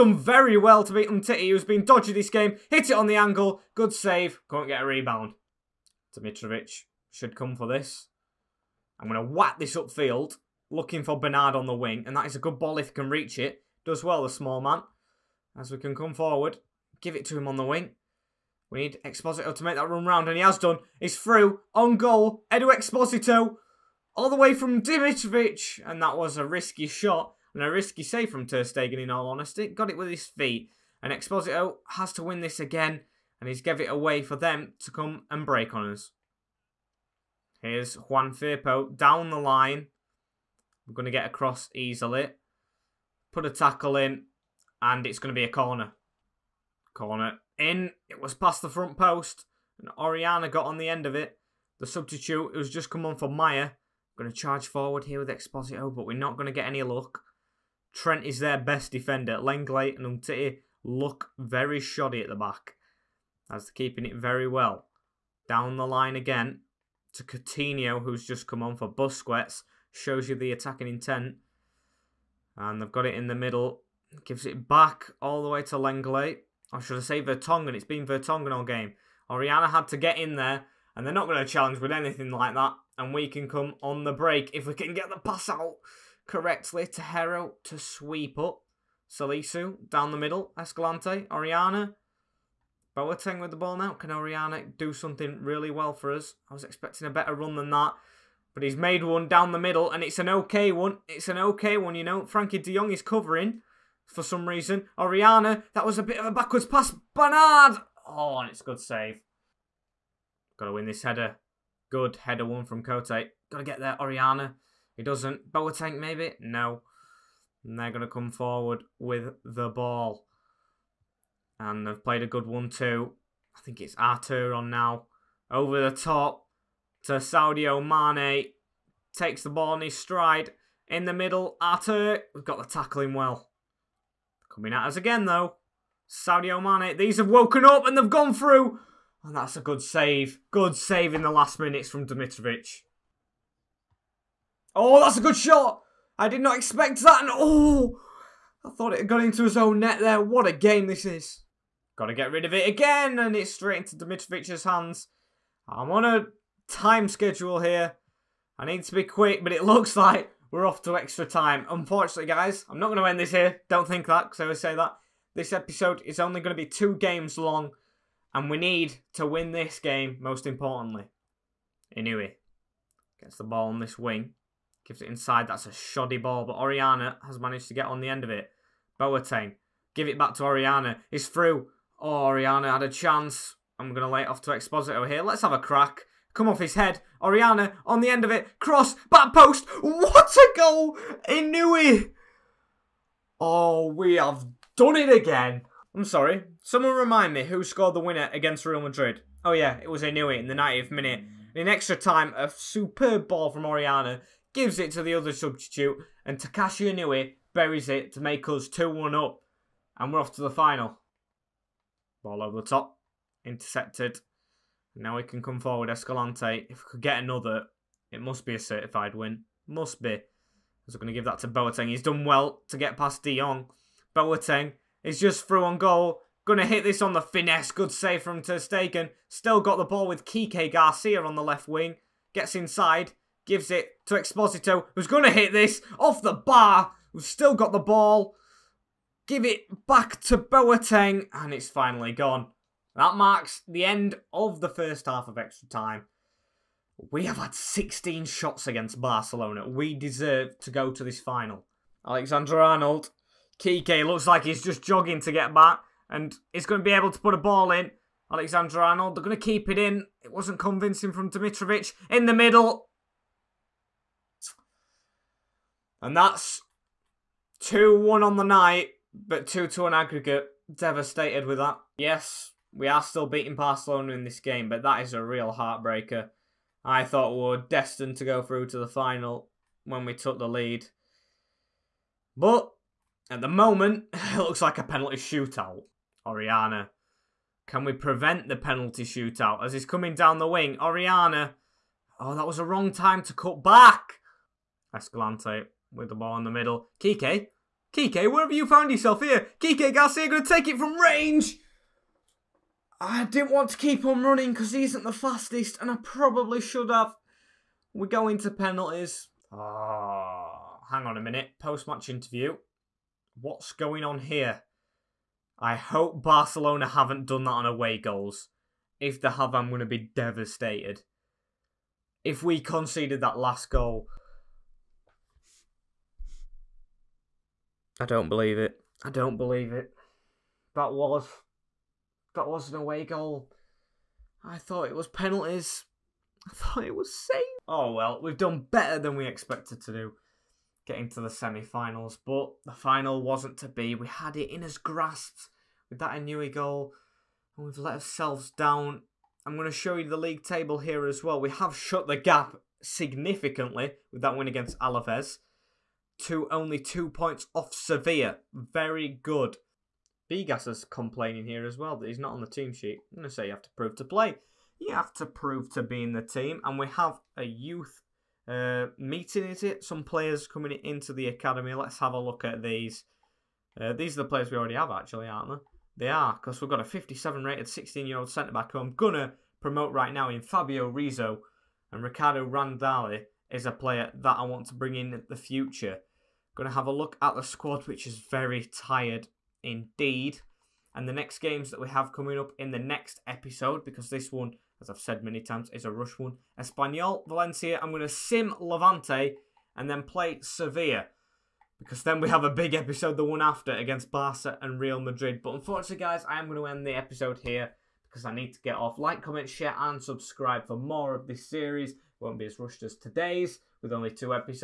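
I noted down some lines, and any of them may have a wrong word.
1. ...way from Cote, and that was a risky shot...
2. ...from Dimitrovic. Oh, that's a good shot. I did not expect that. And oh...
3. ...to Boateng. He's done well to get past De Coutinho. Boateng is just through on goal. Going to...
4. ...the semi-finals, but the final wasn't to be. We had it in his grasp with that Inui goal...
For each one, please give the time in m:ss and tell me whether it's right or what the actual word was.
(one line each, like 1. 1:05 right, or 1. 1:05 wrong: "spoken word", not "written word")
1. 0:24 wrong: "Dimitrovic", not "Cote"
2. 2:21 right
3. 3:41 wrong: "Jong", not "Coutinho"
4. 5:41 right.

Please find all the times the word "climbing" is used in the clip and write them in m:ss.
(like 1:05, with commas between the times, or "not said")
not said.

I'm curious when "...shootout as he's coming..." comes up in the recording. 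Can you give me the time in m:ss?
4:49.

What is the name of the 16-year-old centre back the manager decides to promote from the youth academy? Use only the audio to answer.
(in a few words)
Fabio Rizzo.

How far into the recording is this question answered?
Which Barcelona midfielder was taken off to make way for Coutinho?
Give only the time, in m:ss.
1:08.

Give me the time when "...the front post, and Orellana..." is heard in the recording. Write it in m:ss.
0:48.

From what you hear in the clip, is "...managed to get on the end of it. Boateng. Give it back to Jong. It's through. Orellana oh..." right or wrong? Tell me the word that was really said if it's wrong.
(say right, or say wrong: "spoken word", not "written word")
wrong: "Orellana", not "Jong".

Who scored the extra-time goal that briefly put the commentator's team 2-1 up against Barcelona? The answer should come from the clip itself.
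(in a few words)
Takashi Inui.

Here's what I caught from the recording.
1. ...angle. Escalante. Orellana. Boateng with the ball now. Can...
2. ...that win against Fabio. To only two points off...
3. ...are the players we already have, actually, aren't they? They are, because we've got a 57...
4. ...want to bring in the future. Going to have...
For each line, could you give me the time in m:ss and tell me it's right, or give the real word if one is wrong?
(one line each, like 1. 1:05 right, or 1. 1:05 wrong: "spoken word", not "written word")
1. 1:30 wrong: "middle", not "angle"
2. 5:54 wrong: "Alaves", not "Fabio"
3. 6:14 right
4. 6:24 right.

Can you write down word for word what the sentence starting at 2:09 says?
Takes the ball on his stride.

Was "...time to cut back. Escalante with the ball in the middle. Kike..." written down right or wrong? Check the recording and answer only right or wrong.
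right.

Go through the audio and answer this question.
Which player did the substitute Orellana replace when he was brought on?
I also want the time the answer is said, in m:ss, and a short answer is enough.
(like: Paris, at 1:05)
Majer, at 0:53.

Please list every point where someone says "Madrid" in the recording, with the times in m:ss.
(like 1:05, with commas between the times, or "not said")
3:18, 6:44.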